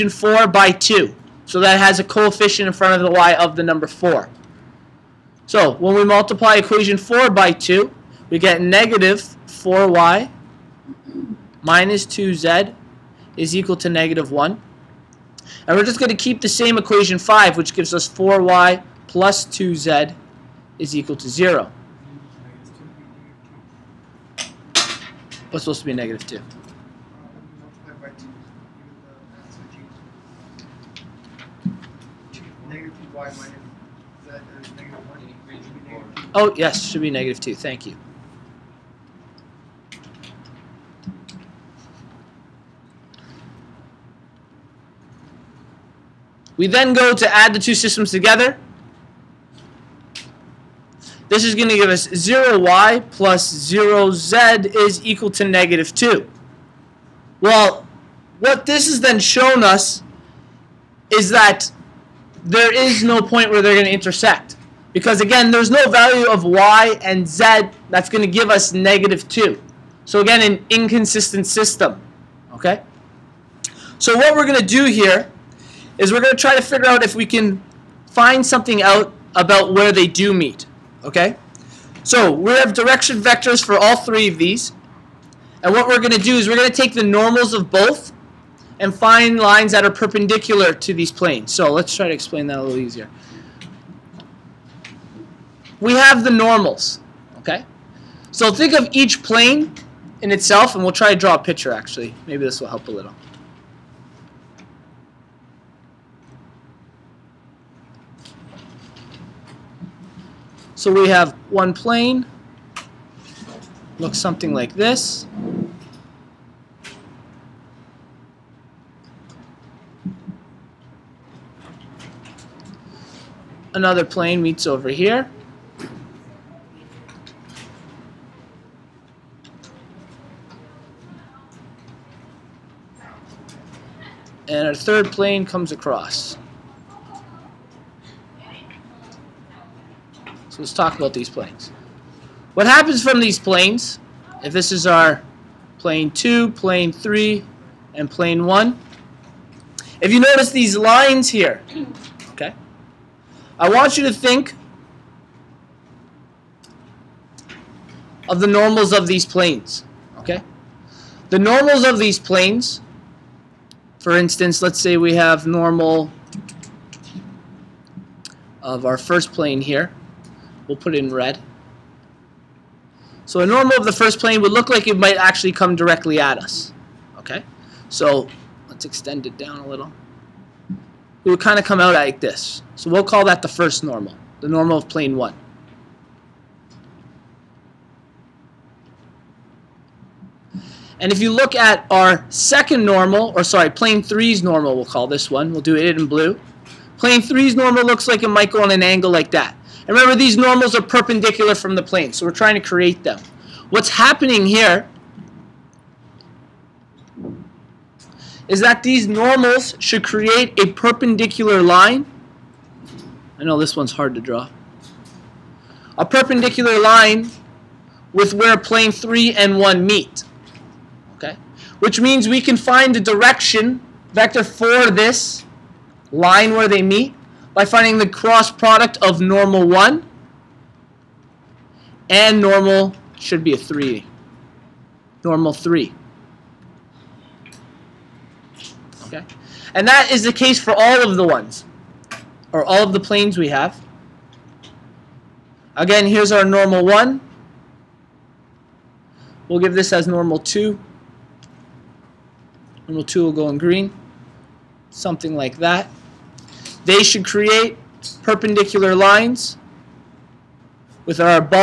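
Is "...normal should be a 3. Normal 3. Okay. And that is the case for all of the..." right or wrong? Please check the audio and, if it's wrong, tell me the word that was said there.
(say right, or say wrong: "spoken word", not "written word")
right.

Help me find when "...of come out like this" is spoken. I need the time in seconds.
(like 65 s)
181 s.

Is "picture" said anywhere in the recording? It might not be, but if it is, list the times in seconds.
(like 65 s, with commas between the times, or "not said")
101 s.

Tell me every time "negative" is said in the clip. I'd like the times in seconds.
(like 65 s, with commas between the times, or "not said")
8 s, 13 s, 25 s, 37 s, 55 s, 68 s.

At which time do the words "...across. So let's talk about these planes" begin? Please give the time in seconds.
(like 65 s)
135 s.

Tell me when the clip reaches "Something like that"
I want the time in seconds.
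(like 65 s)
254 s.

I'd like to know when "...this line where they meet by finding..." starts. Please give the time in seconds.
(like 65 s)
224 s.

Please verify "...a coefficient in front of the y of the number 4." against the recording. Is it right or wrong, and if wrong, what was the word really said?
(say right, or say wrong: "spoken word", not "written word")
right.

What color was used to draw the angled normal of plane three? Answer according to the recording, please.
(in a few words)
blue.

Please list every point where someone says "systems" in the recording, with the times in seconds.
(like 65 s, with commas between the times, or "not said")
47 s, 71 s.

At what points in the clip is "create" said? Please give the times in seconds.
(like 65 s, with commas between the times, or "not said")
202 s, 210 s, 257 s.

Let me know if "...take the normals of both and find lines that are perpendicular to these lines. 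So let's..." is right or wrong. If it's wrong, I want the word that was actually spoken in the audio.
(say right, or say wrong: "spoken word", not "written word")
wrong: "planes", not "lines".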